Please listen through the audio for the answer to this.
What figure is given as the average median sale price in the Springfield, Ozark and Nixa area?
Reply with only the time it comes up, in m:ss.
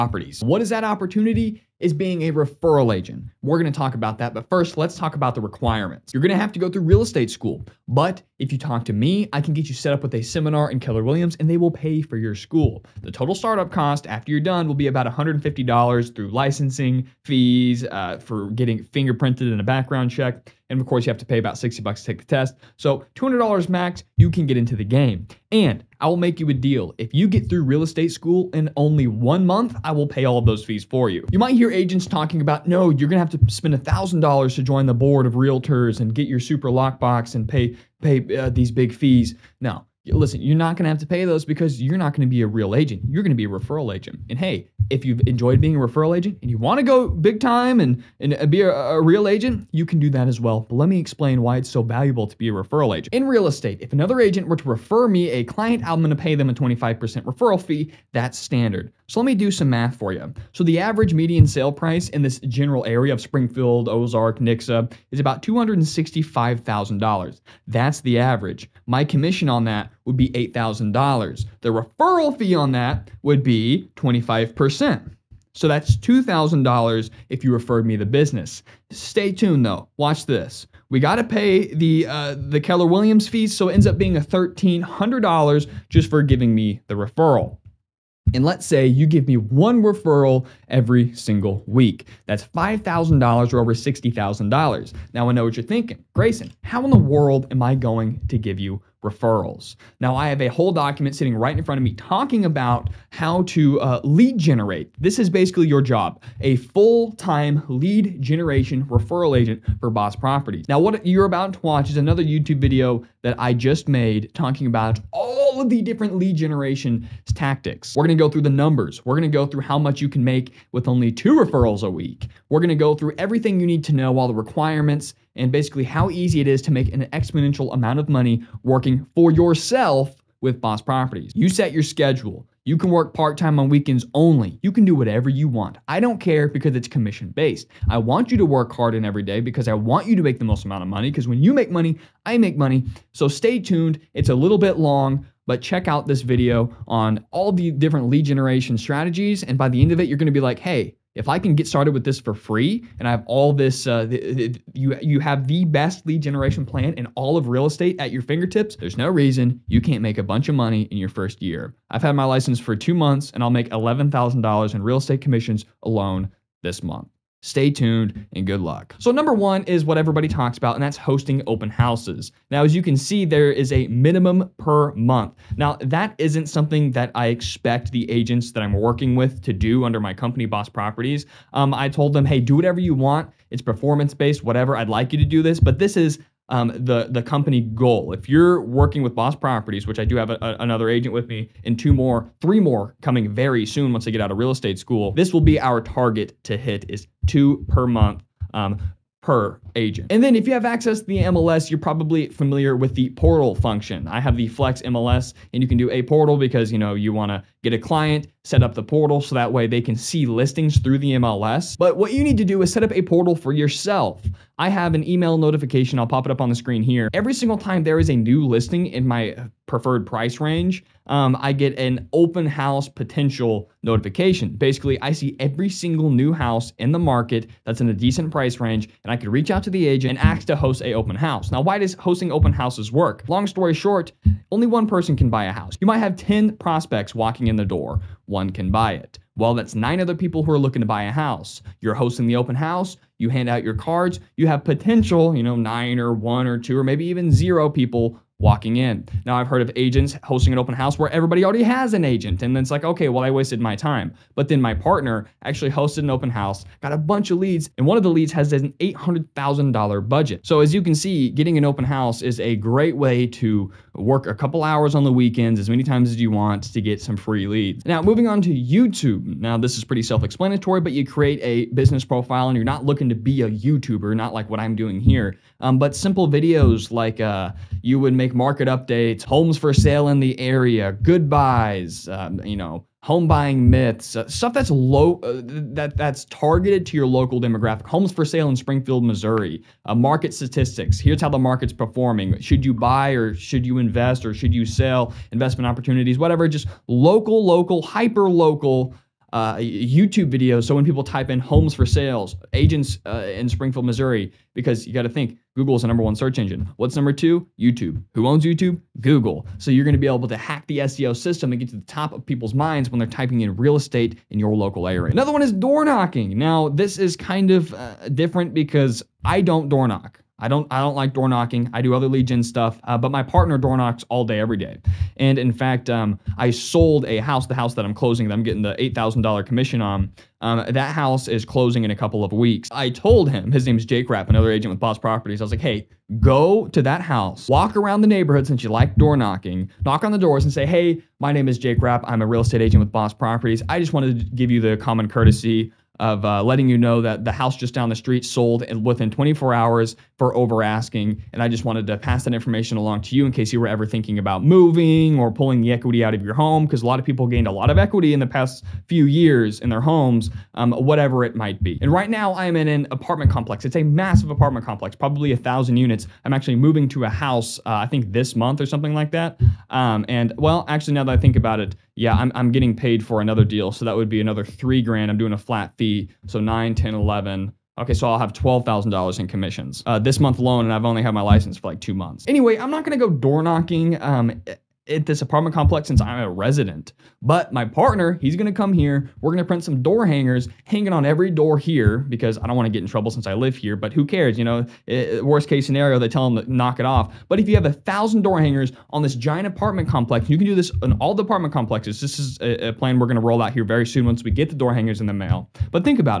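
1:05.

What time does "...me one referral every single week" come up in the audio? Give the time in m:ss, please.
1:29.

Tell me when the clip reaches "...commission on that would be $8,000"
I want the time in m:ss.
1:09.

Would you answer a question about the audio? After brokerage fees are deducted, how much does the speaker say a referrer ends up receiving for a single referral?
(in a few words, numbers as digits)
$1,300.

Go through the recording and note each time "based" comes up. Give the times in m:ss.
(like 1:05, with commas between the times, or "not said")
2:17, 3:04.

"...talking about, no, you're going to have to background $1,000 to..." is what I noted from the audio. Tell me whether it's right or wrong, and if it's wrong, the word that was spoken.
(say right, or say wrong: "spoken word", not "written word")
wrong: "spend", not "background".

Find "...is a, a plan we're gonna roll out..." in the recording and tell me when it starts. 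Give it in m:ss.
6:42.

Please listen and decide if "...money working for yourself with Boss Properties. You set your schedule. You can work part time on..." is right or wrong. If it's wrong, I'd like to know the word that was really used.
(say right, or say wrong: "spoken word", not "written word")
right.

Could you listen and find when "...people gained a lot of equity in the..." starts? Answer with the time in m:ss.
5:57.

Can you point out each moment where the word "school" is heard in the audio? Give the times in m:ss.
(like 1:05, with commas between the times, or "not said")
0:07, 0:12, 0:28, 3:14.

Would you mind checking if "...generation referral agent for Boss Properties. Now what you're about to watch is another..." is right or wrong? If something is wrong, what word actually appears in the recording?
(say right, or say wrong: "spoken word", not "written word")
right.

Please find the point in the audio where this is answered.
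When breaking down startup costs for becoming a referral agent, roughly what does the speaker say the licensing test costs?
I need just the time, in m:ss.
0:21.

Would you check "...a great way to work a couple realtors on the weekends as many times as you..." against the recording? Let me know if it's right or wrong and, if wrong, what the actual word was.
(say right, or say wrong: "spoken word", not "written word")
wrong: "hours", not "realtors".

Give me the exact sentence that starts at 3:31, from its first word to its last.
But what you need to do is set up a portal for yourself.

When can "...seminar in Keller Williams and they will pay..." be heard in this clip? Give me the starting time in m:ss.
0:10.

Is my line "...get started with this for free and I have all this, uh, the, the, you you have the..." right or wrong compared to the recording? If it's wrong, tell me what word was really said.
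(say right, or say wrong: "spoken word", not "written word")
right.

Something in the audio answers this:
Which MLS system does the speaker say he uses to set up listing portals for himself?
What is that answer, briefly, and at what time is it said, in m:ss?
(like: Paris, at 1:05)
Flex MLS, at 3:24.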